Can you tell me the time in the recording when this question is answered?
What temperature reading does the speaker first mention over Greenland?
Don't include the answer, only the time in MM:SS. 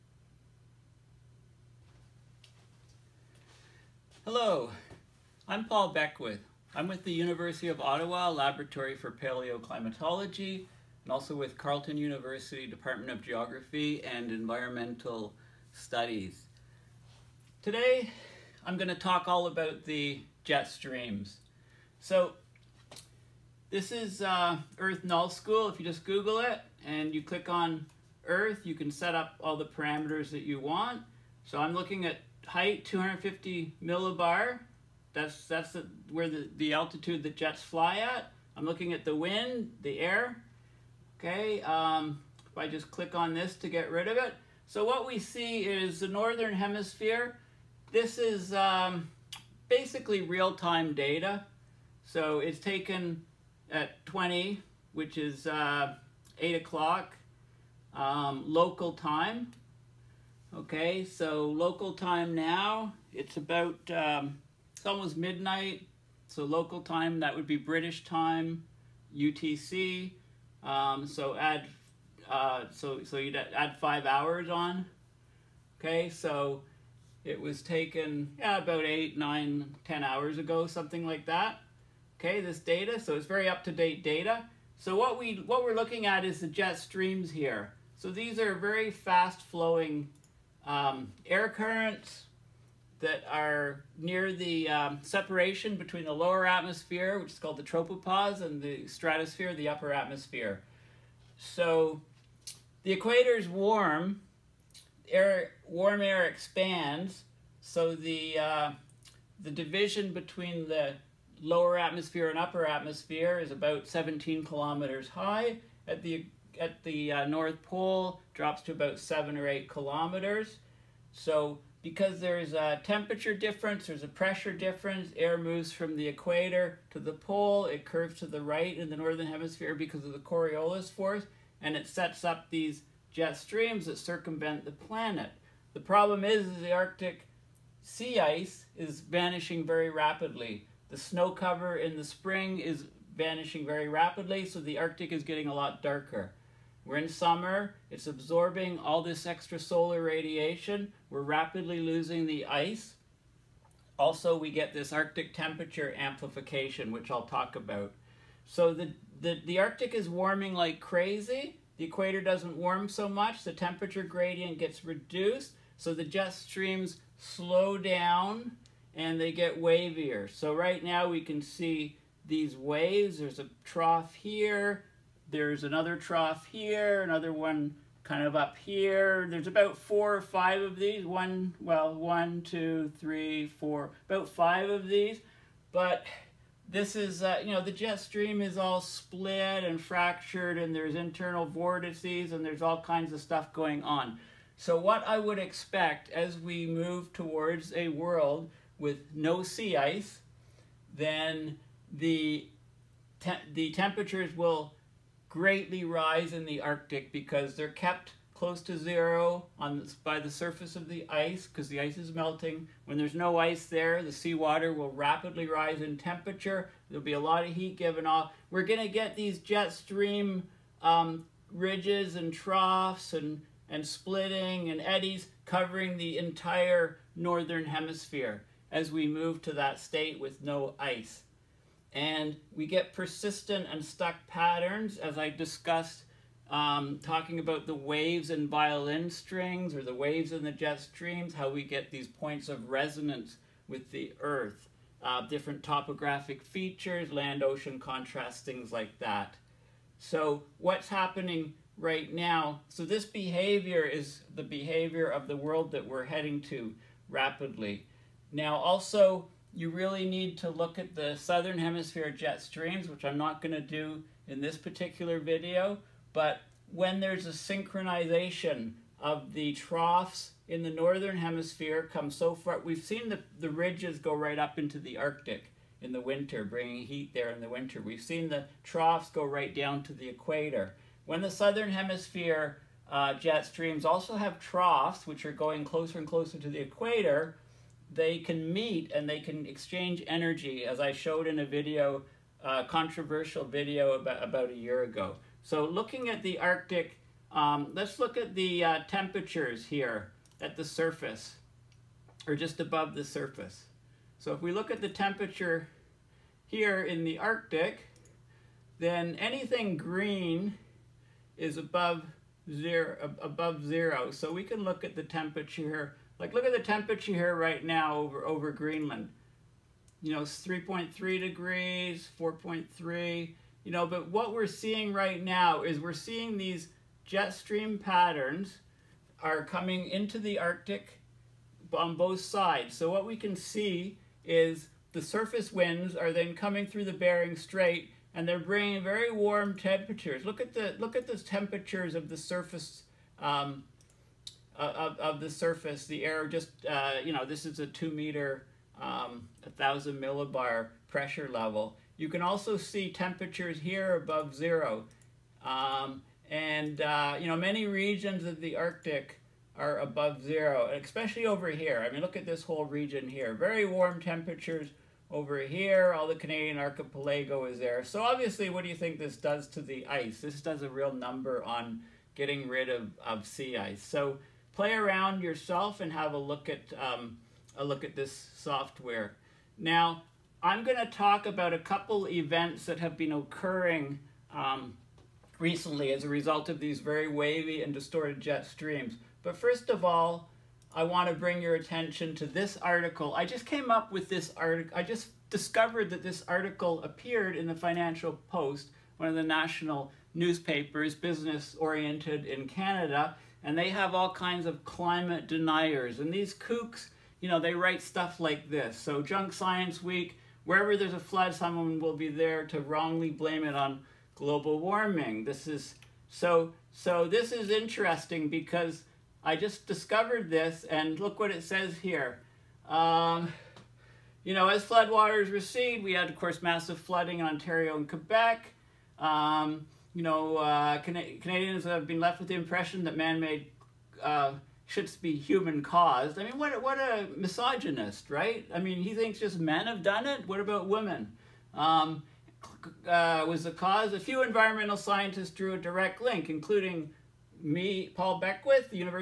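05:20.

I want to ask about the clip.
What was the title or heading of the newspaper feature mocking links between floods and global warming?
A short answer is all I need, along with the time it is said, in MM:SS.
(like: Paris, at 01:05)
Junk Science Week, at 06:49.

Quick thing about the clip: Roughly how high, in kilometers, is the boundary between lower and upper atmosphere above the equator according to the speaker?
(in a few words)
17 kilometers.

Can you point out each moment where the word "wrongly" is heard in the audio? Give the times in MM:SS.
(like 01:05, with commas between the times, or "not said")
06:52.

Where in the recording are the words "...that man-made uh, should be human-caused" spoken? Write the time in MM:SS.
07:12.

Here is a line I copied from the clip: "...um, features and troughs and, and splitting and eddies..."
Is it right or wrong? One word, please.
wrong.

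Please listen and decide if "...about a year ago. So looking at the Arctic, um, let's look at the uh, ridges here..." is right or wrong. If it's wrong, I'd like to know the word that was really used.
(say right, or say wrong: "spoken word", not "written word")
wrong: "temperatures", not "ridges".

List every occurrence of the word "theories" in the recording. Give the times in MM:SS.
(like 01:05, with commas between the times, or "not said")
not said.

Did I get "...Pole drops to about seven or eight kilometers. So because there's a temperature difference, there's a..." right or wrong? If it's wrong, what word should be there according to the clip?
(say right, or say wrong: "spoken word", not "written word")
right.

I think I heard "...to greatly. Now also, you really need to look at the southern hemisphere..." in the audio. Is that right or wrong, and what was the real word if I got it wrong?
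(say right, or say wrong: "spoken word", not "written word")
wrong: "rapidly", not "greatly".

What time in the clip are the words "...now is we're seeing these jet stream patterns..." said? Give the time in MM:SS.
05:25.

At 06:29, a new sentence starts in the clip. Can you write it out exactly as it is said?
But first of all, I want to bring your attention to this article.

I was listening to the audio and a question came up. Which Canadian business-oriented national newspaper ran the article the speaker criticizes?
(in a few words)
Financial Post.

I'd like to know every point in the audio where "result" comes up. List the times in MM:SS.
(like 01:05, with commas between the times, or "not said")
06:26.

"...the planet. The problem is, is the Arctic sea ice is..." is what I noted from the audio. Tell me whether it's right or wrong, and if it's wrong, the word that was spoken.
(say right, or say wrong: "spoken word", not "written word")
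right.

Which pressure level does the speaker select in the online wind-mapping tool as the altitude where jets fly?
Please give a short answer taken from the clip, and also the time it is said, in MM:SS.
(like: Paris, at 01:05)
250 millibar, at 00:32.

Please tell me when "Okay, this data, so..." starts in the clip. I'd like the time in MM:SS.
01:22.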